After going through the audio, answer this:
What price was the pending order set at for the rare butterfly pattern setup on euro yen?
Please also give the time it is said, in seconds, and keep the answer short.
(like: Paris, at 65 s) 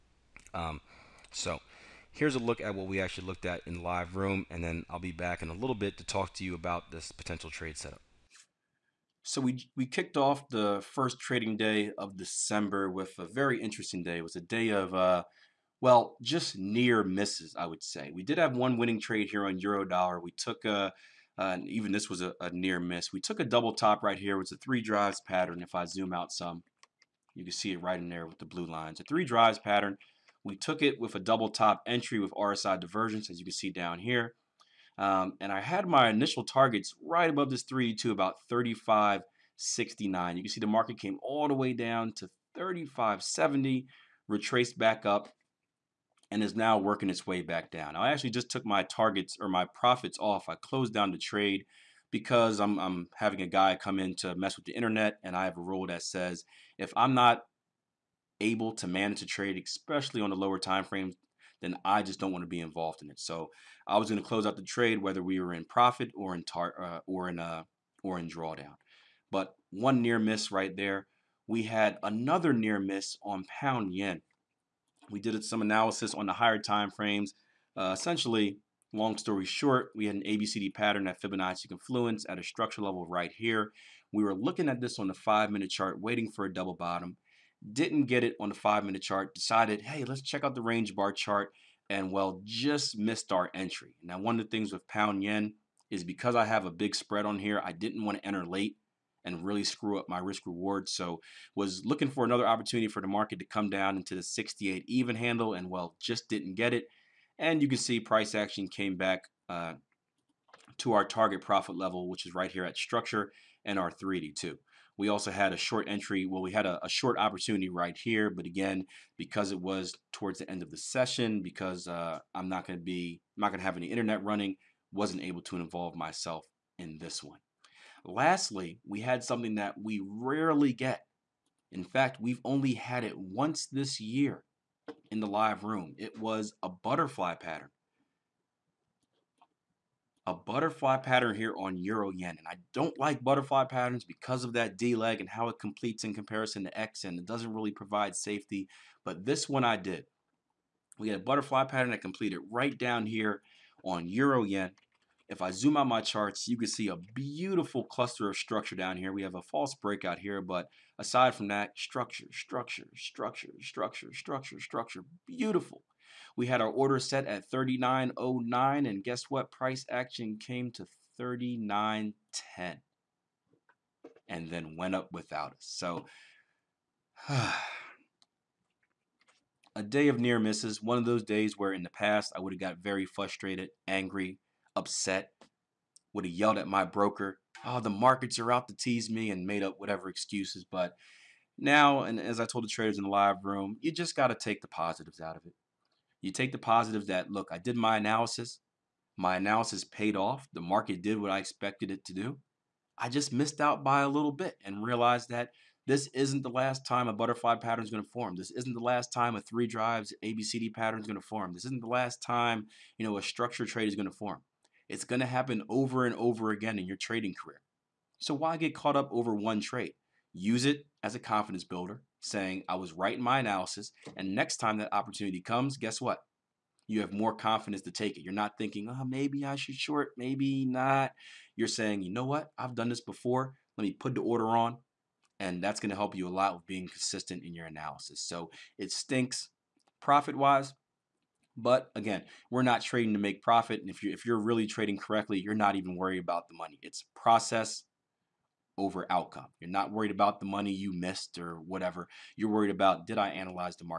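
39.09, at 167 s.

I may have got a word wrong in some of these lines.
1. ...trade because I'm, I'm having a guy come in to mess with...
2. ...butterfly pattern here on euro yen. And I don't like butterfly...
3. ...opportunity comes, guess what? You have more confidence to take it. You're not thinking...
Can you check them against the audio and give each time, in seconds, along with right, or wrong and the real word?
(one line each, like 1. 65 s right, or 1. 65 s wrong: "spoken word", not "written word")
1. 51 s right
2. 140 s right
3. 224 s right.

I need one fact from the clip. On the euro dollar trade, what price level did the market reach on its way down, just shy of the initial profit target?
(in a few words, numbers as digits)
35.70.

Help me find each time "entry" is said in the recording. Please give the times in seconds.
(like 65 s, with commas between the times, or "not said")
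31 s, 93 s, 115 s.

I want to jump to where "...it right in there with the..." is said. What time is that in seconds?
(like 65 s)
27 s.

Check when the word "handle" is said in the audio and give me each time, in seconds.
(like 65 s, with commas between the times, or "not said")
105 s.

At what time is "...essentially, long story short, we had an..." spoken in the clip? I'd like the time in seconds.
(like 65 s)
77 s.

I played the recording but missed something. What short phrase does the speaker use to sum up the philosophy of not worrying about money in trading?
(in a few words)
Process over outcome.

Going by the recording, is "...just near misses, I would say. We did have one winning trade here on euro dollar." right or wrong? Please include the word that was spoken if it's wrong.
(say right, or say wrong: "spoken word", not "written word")
right.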